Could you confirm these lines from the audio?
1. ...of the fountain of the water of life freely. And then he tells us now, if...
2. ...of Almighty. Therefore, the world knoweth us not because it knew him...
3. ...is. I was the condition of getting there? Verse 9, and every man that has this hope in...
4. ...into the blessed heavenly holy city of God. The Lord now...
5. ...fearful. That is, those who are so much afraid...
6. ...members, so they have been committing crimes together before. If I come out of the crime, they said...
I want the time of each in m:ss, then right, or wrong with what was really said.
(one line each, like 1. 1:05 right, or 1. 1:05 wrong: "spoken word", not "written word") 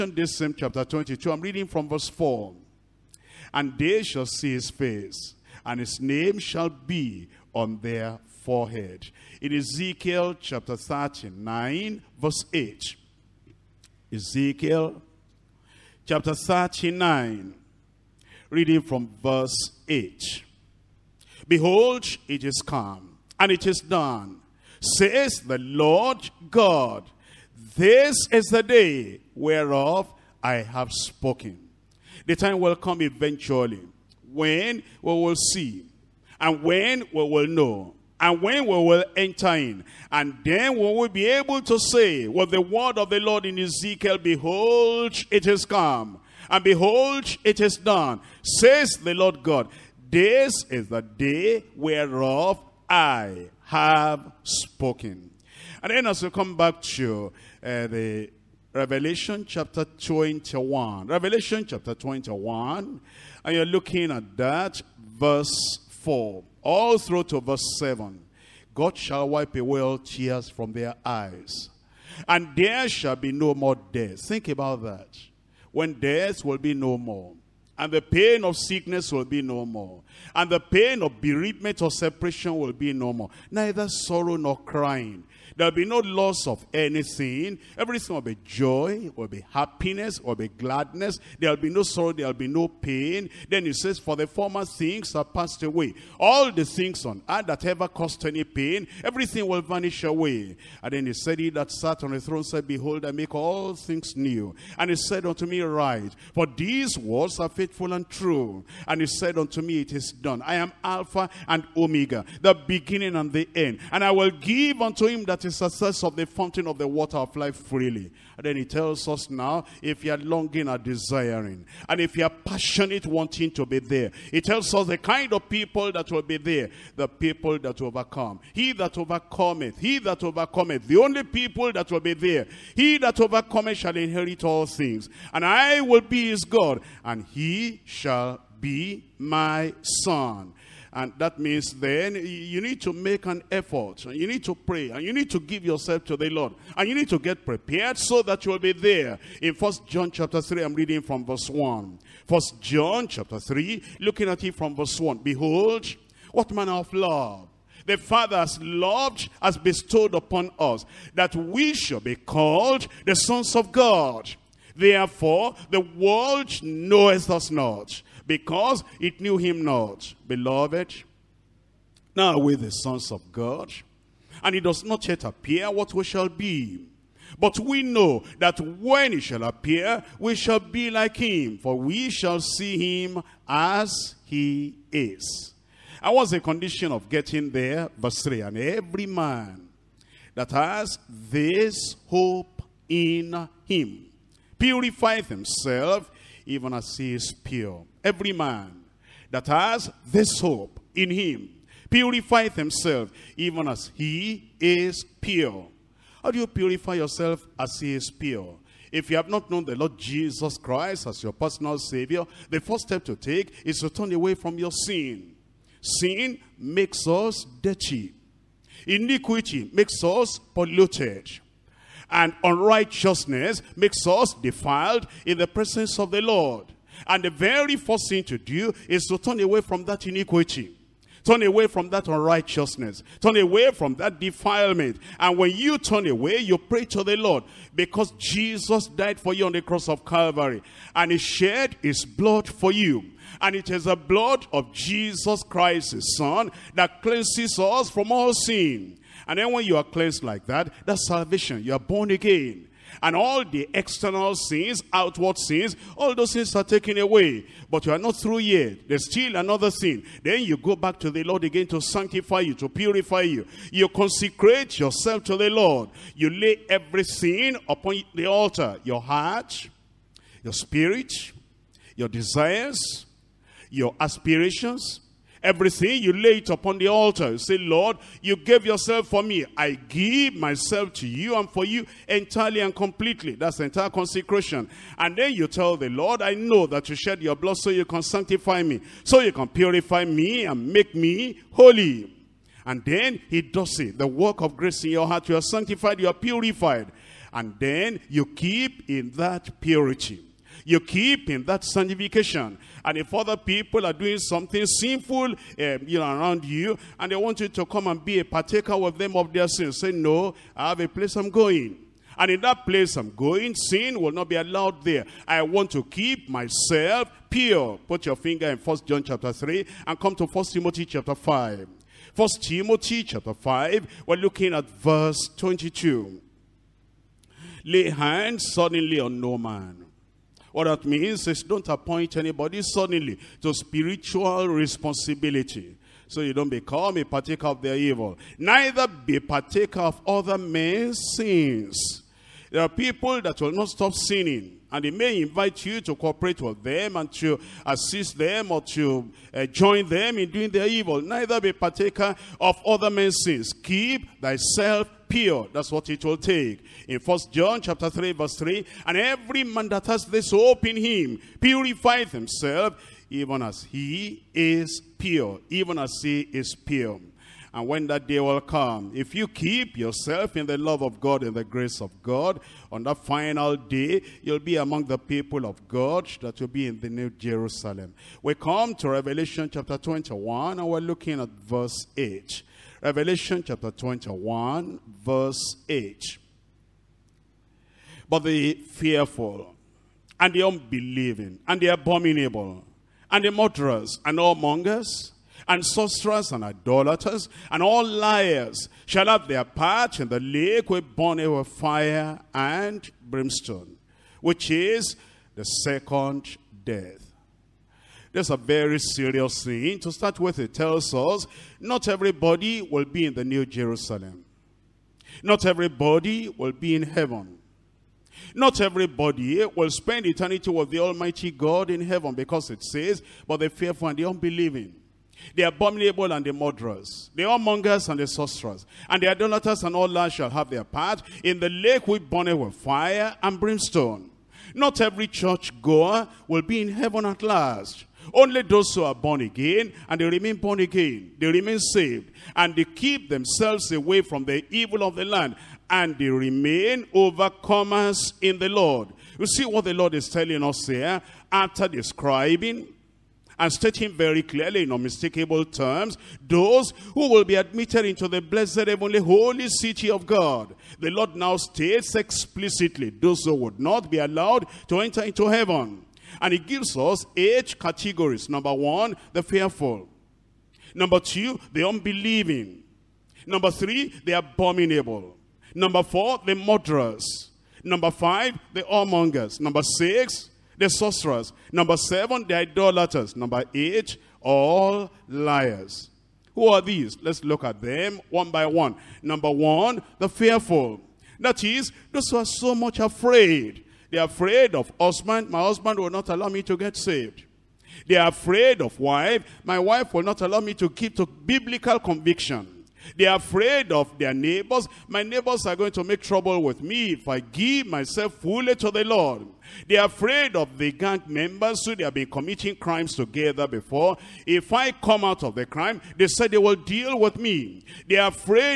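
1. 1:56 right
2. 2:43 wrong: "God", not "Almighty"
3. 3:04 wrong: "3", not "9"
4. 7:37 right
5. 8:10 right
6. 8:31 right.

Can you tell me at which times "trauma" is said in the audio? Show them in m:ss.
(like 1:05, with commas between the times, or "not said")
not said.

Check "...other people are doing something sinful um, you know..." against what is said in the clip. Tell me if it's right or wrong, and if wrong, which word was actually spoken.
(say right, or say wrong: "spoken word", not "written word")
right.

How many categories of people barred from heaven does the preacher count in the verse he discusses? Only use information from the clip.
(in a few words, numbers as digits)
8.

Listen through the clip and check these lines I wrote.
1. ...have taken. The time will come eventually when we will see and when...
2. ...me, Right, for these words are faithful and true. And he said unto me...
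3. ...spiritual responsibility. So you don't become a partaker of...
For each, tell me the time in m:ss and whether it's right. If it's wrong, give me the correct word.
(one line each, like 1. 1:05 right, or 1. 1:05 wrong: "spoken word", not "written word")
1. 0:30 wrong: "spoken", not "taken"
2. 1:45 right
3. 5:33 right.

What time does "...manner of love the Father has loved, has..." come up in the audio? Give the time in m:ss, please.
2:36.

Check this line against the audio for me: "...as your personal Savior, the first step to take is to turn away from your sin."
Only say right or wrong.
right.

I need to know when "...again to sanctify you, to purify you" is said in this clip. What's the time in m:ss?
4:21.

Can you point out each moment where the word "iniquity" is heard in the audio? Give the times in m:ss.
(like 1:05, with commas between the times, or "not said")
3:38, 3:50.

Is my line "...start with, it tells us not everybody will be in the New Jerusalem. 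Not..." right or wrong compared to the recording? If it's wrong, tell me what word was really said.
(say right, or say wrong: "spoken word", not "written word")
right.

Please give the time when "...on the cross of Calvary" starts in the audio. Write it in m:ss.
3:59.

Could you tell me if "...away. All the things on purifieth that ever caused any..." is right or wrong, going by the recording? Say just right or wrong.
wrong.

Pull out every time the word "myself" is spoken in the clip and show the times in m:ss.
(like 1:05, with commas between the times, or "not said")
4:40, 5:16, 8:27.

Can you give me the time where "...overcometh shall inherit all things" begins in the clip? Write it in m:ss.
2:13.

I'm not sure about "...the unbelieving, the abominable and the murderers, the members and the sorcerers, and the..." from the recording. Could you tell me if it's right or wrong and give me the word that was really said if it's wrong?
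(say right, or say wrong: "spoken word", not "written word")
wrong: "whoremongers", not "members".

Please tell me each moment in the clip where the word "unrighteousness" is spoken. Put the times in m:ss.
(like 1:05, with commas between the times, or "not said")
3:42, 3:52.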